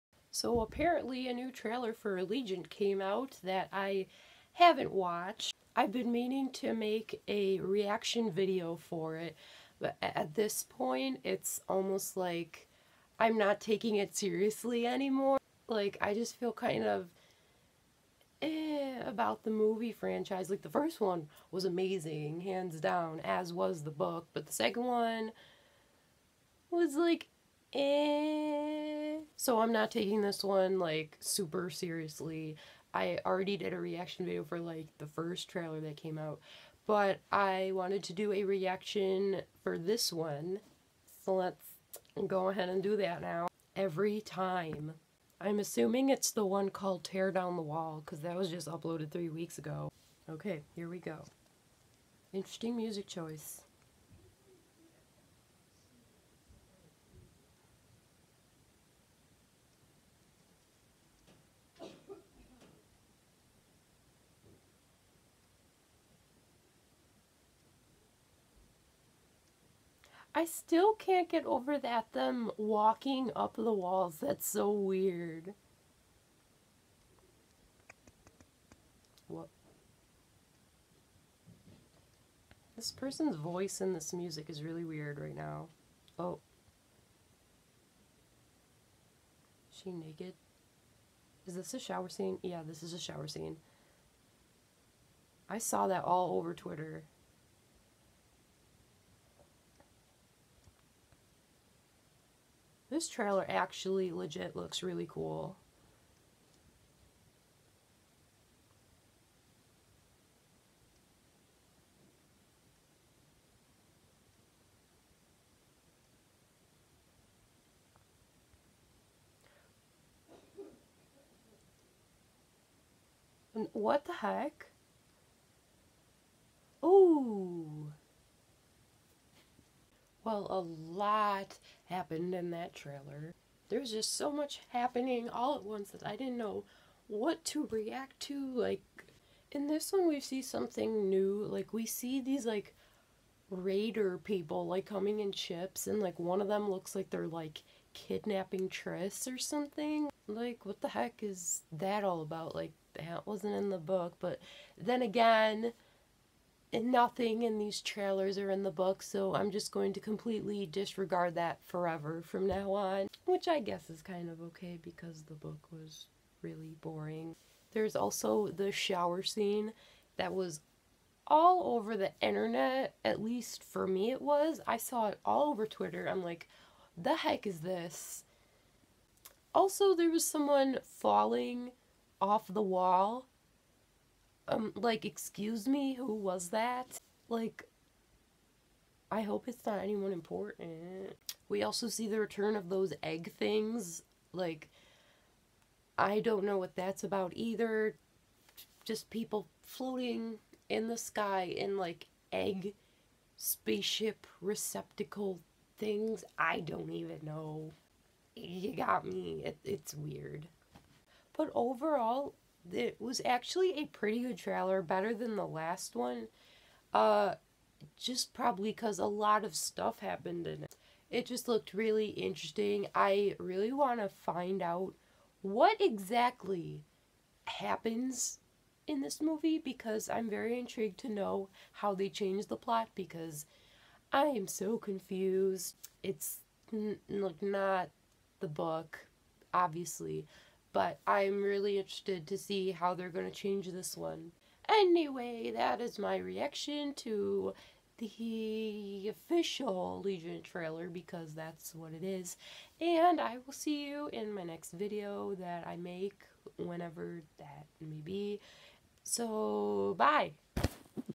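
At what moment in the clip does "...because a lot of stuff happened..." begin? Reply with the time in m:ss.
3:38.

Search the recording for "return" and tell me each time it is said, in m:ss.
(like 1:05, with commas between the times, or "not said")
3:12.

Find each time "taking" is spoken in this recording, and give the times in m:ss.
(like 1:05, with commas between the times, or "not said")
0:13, 0:29.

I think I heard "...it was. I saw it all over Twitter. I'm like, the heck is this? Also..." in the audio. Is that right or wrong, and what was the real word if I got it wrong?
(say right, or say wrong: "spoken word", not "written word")
right.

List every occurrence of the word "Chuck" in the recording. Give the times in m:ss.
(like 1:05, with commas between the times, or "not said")
not said.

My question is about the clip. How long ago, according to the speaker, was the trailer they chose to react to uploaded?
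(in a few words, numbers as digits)
3 weeks ago.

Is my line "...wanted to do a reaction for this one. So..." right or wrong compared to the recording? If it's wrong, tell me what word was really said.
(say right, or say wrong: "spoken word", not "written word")
right.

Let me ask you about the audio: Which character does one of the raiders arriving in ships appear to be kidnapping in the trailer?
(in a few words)
Tris.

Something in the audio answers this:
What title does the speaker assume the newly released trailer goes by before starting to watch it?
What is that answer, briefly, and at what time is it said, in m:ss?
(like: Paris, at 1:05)
Tear Down the Wall, at 0:47.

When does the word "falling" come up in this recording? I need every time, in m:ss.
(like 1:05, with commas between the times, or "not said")
3:00.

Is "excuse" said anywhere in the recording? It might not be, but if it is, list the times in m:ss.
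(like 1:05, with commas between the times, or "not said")
3:05.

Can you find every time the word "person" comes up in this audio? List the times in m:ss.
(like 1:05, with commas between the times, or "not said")
1:22.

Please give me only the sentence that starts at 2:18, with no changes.
Like, in this one, we see something new.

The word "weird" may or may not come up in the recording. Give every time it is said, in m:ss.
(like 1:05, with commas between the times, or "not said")
1:14, 1:24, 3:29.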